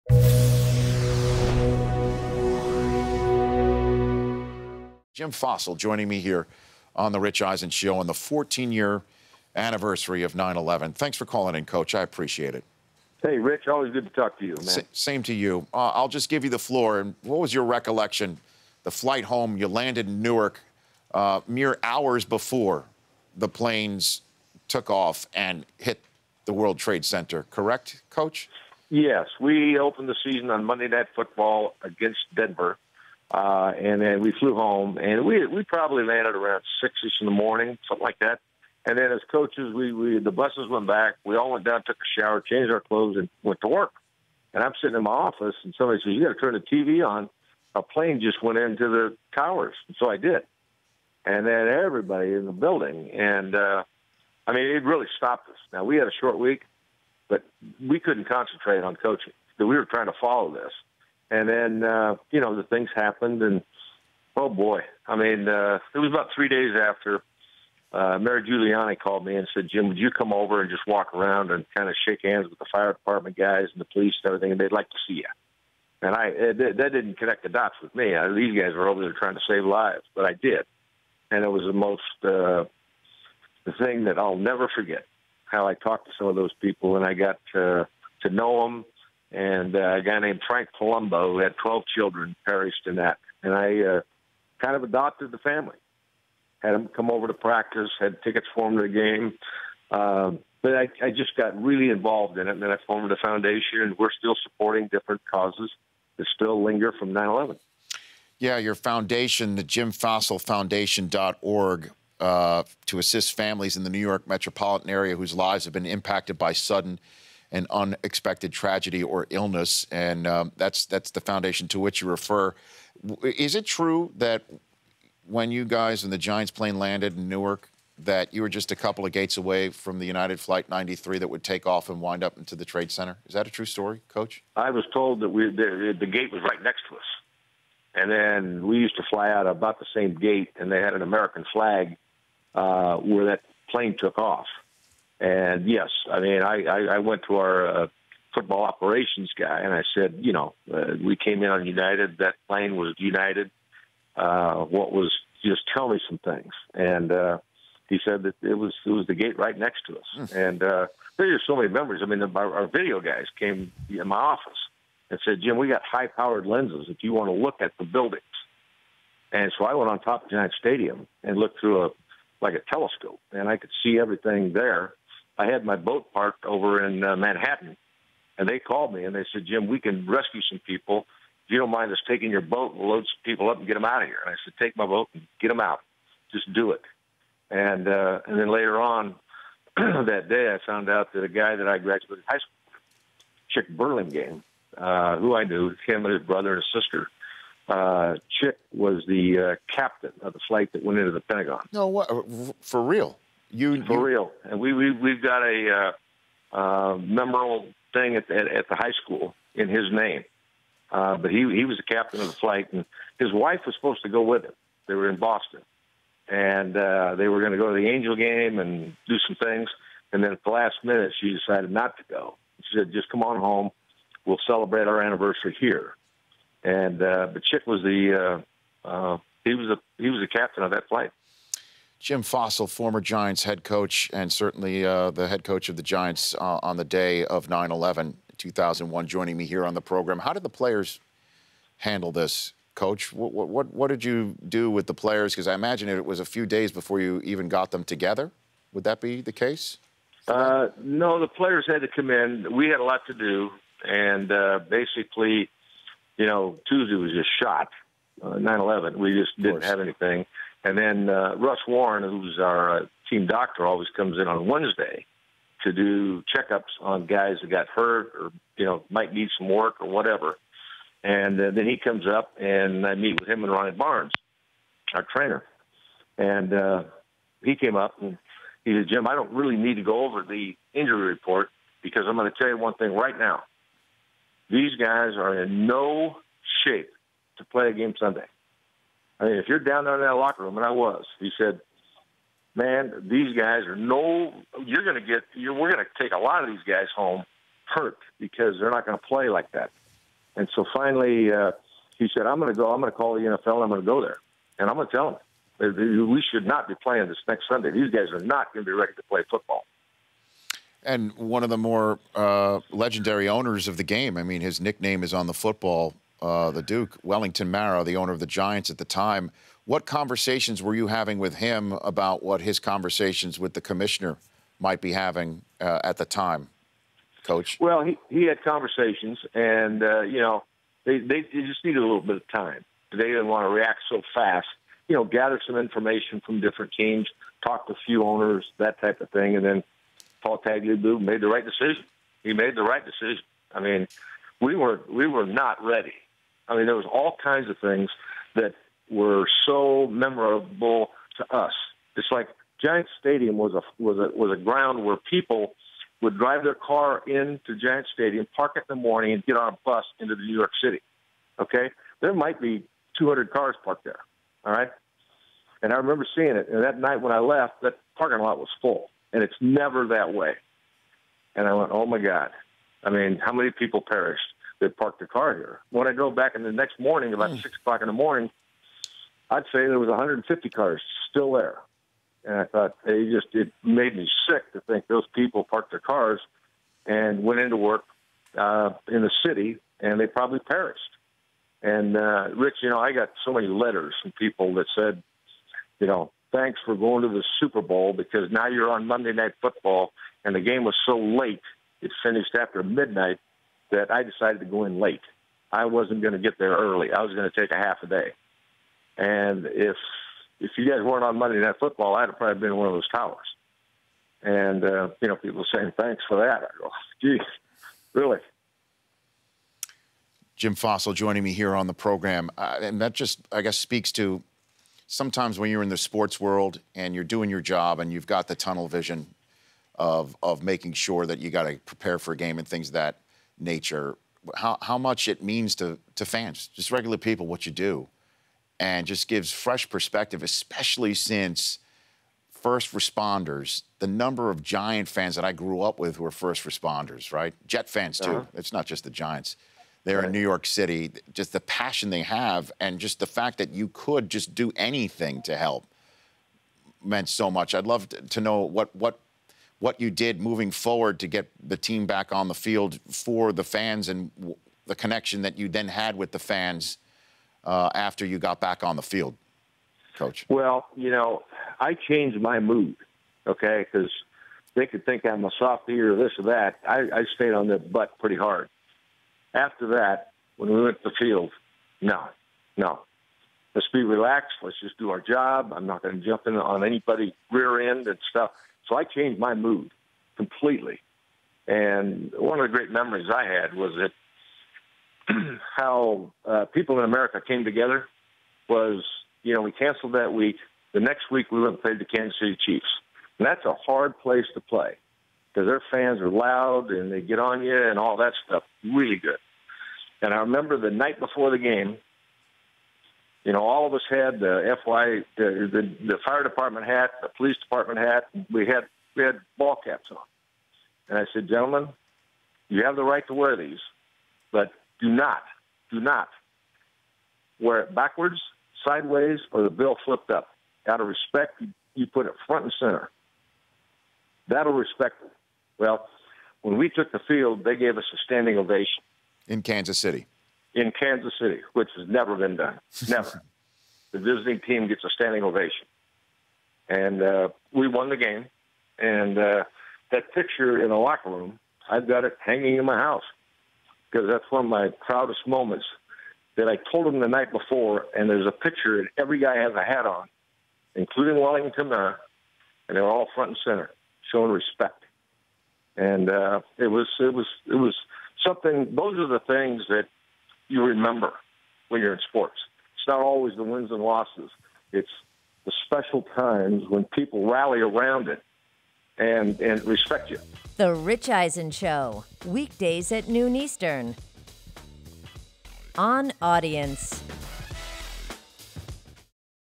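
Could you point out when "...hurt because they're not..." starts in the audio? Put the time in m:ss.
4:57.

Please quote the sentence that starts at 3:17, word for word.
Uh, Chick was the uh, captain of the flight that went into the Pentagon.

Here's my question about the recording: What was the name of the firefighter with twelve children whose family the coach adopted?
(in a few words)
Frank Palumbo.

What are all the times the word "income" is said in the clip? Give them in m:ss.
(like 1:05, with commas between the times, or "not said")
not said.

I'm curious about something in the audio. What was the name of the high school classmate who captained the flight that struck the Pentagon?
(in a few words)
Chick Burlingame.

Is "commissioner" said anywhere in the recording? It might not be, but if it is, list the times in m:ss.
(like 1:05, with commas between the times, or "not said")
5:23.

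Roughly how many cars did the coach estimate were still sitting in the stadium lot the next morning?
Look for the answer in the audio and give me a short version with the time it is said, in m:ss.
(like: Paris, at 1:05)
150, at 6:19.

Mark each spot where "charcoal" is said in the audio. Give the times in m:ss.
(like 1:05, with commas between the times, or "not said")
not said.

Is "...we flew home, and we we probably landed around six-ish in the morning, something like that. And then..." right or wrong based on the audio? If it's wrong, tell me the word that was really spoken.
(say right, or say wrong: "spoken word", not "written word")
right.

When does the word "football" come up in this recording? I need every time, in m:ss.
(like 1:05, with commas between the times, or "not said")
0:31, 2:28, 5:09, 5:15, 6:39, 6:51.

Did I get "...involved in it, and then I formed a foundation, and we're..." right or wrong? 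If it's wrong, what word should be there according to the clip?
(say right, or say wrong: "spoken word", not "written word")
right.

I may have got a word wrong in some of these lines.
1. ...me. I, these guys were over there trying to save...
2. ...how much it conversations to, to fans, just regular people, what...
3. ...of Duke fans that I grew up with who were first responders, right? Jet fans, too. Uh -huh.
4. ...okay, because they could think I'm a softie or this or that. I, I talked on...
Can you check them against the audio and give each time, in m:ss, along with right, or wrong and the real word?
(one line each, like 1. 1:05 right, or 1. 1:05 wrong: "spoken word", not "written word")
1. 1:17 right
2. 7:14 wrong: "means", not "conversations"
3. 7:24 wrong: "Giant", not "Duke"
4. 7:53 wrong: "stayed", not "talked".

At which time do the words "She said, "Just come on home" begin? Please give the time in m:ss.
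3:42.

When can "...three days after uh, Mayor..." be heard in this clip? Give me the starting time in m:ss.
1:06.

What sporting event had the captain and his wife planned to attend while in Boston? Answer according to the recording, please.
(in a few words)
the Angel game.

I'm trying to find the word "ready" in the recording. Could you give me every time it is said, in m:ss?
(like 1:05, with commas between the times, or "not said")
5:08, 5:45.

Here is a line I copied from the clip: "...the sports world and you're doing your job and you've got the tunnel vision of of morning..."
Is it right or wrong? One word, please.
wrong.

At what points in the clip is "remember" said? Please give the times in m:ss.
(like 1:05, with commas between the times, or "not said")
6:05, 8:30, 9:30.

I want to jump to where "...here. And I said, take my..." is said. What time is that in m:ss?
3:04.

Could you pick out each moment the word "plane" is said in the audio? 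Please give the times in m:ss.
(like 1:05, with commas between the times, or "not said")
0:23, 0:47, 2:06, 2:23, 2:32.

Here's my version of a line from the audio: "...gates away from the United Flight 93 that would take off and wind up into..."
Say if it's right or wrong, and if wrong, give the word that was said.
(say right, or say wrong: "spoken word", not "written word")
right.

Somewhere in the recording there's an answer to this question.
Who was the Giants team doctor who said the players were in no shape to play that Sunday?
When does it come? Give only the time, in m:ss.
4:21.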